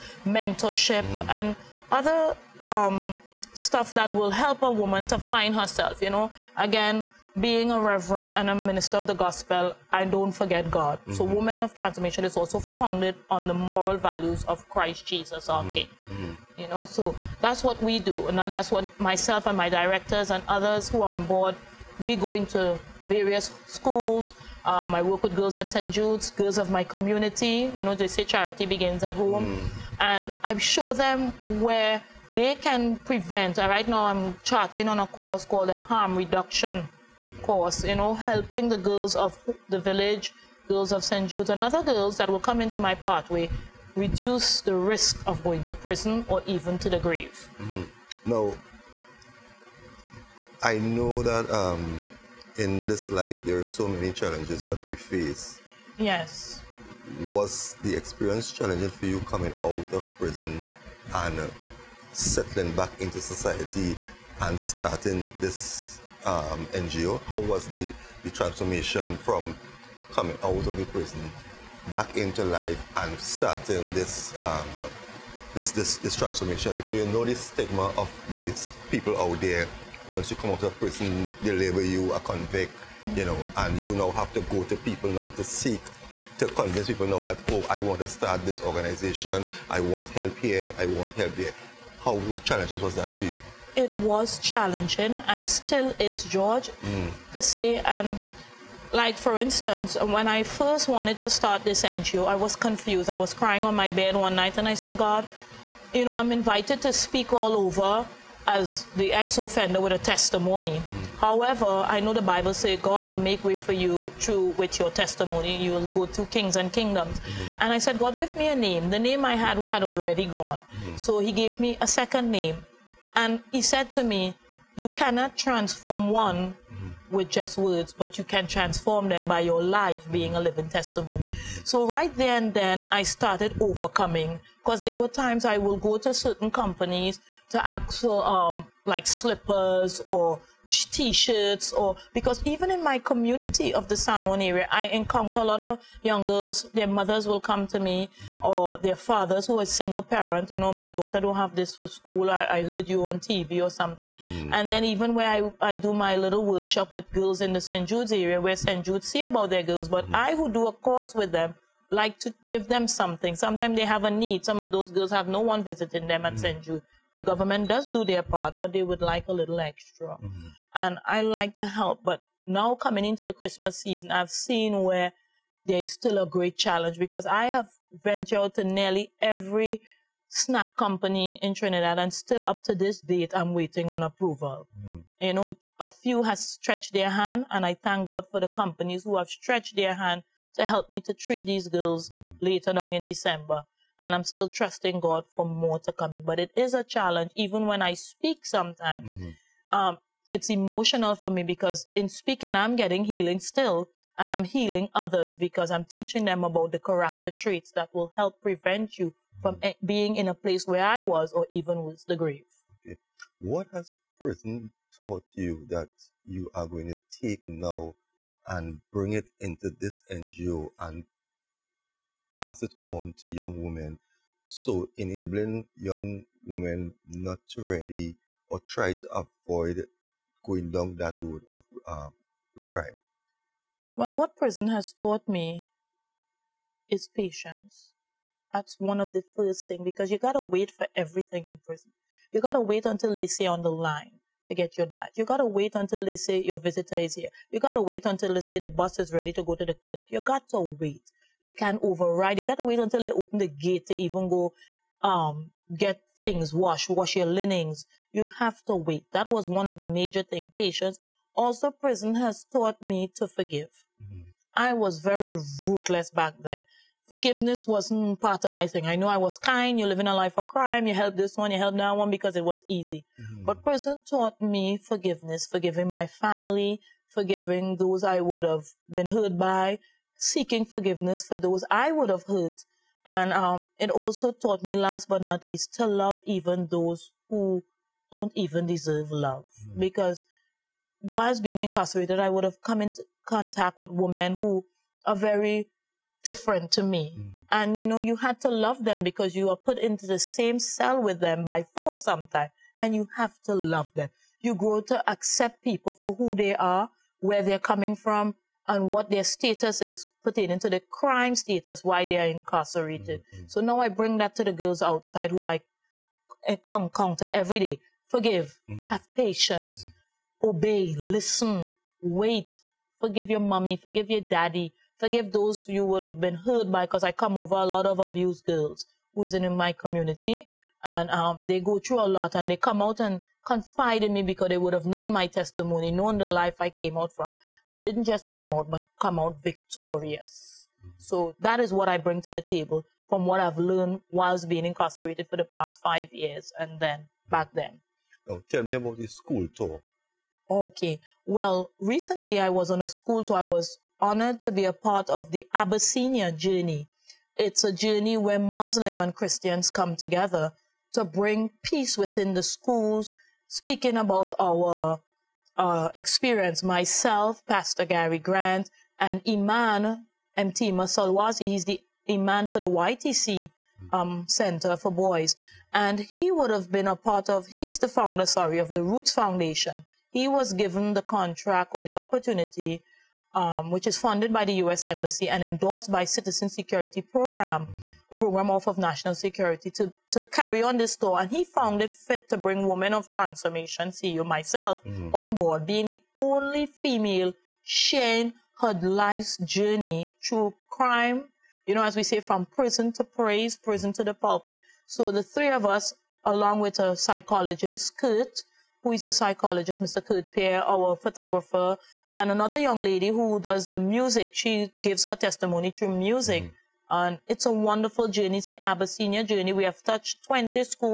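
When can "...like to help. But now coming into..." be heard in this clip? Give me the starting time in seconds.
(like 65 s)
171 s.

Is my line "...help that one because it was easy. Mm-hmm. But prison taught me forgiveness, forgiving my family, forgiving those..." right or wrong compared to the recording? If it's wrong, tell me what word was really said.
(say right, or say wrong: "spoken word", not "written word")
right.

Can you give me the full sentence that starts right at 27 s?
You know, they say charity begins at home.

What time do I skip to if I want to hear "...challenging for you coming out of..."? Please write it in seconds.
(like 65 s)
58 s.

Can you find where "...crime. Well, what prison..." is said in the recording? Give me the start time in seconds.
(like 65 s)
232 s.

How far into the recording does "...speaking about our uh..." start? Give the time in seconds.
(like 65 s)
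363 s.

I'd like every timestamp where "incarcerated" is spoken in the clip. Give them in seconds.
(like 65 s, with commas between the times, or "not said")
291 s, 312 s, 344 s.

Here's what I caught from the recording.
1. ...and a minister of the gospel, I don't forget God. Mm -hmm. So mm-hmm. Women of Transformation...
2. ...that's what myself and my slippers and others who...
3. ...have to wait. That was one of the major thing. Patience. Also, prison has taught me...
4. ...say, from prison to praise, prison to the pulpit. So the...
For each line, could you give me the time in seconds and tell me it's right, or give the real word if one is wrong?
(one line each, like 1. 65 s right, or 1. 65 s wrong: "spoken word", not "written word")
1. 8 s right
2. 18 s wrong: "directors", not "slippers"
3. 258 s right
4. 402 s right.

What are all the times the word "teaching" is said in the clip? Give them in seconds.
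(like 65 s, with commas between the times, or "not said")
205 s.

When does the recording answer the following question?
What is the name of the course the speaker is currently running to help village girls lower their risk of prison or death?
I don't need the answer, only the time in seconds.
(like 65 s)
35 s.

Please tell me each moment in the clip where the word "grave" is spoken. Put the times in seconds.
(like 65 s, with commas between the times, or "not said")
46 s, 212 s.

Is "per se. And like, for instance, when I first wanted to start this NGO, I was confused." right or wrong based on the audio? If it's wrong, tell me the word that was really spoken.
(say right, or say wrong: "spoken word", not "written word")
right.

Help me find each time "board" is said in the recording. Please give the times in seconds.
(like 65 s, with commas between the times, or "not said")
21 s, 395 s.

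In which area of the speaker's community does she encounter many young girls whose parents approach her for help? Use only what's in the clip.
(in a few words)
San Juan.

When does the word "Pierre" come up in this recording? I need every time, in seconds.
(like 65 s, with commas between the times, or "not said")
410 s.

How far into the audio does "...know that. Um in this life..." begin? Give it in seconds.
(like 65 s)
50 s.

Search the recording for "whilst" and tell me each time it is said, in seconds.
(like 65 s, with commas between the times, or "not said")
291 s, 344 s.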